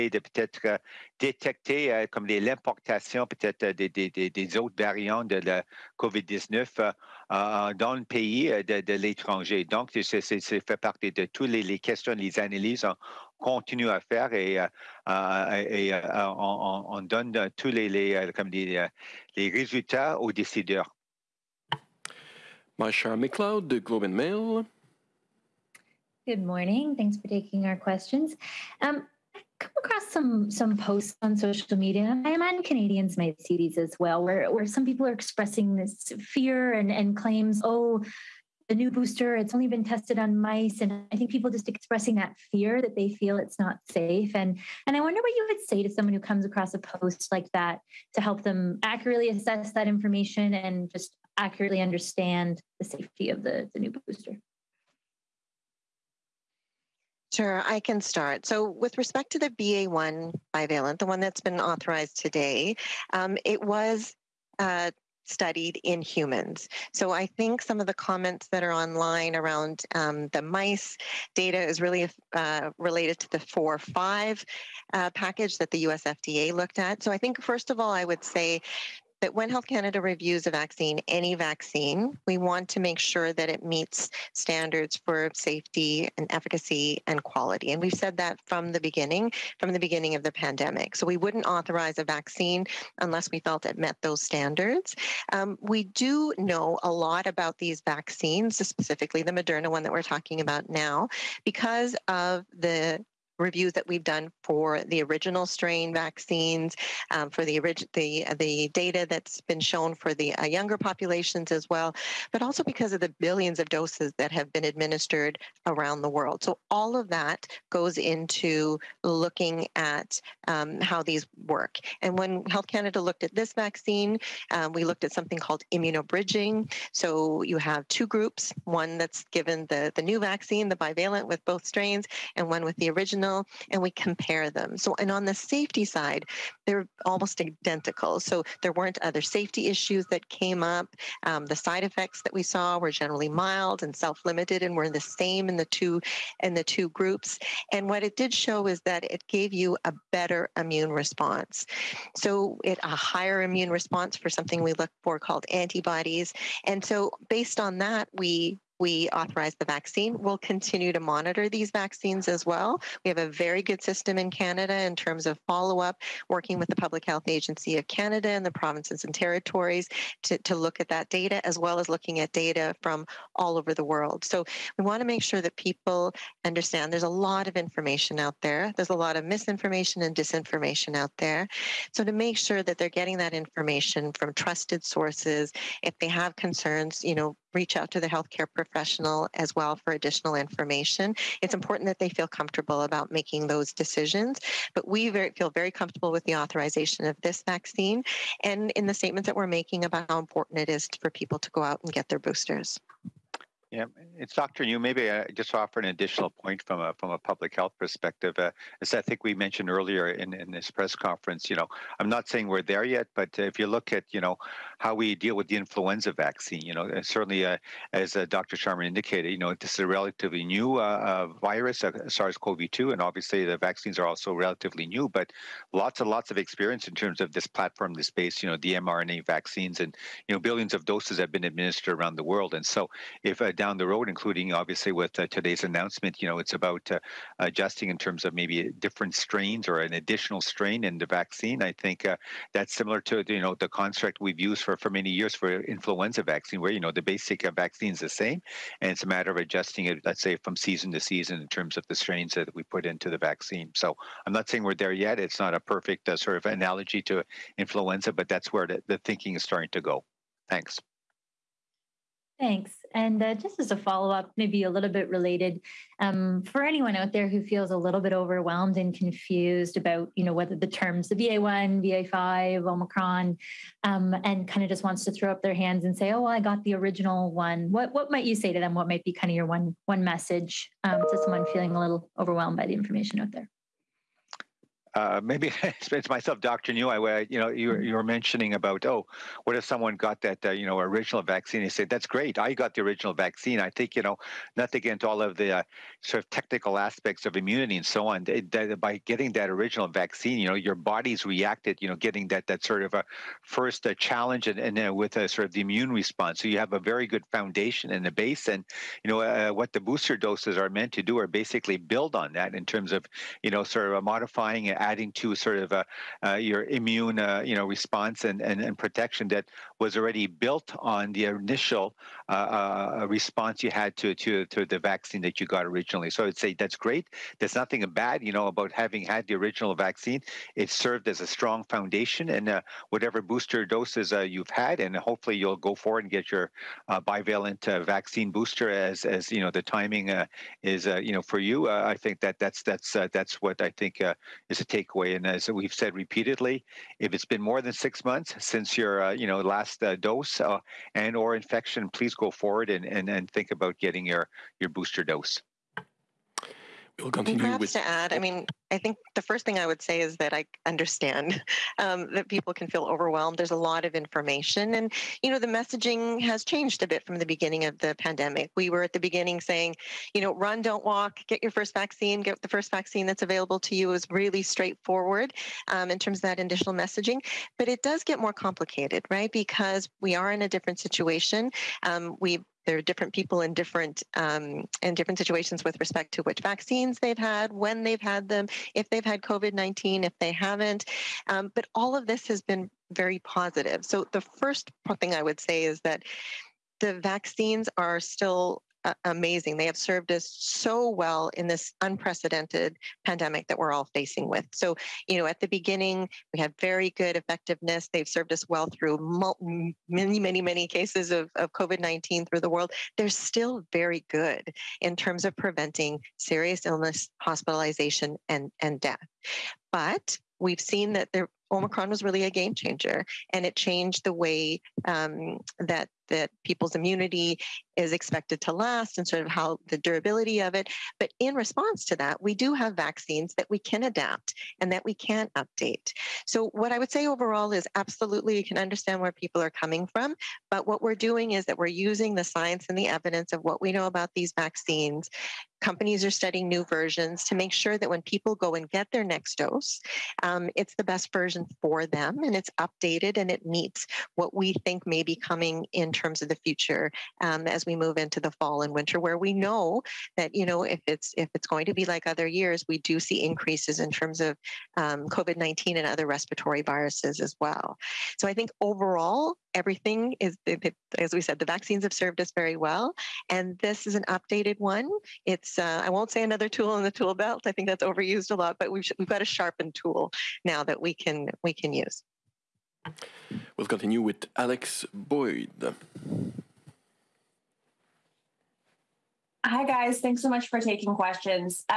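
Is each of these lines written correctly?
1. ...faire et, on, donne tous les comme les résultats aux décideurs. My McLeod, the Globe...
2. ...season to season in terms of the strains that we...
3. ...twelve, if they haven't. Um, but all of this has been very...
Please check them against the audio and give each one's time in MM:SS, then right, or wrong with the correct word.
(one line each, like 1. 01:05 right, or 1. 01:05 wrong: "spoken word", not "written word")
1. 00:14 right
2. 04:10 right
3. 06:29 wrong: "nineteen", not "twelve".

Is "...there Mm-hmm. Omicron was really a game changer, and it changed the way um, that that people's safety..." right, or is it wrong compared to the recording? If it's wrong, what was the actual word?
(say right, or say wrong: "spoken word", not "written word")
wrong: "immunity", not "safety".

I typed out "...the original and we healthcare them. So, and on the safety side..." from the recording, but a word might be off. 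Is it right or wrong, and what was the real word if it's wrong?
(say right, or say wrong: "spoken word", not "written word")
wrong: "compare", not "healthcare".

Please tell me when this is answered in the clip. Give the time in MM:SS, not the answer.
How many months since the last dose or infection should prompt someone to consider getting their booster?
05:47.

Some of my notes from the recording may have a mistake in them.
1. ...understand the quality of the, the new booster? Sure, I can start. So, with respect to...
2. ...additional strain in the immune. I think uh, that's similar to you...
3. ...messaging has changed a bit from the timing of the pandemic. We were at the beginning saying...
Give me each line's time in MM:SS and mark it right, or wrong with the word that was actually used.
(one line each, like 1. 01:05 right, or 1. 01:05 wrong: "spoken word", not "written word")
1. 00:51 wrong: "safety", not "quality"
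2. 03:59 wrong: "vaccine", not "immune"
3. 06:05 wrong: "beginning", not "timing".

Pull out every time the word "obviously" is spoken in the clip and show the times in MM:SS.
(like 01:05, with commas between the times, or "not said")
03:43, 03:54.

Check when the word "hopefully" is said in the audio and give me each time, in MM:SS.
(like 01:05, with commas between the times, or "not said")
05:34.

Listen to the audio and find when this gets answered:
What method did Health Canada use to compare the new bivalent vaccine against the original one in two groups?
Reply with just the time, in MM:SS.
02:05.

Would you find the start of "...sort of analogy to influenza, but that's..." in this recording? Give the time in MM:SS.
04:16.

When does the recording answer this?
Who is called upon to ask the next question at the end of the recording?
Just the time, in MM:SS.
08:04.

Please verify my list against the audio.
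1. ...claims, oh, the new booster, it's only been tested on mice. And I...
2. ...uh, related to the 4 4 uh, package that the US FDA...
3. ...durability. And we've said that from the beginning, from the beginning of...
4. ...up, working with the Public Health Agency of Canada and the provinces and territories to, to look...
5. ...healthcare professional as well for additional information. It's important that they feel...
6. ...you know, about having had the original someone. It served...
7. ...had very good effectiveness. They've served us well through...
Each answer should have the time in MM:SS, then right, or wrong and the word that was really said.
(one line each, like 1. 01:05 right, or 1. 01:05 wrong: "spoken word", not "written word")
1. 00:37 right
2. 01:12 wrong: "5", not "4"
3. 01:27 wrong: "quality", not "durability"
4. 02:45 right
5. 03:08 right
6. 05:28 wrong: "vaccine", not "someone"
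7. 06:46 right.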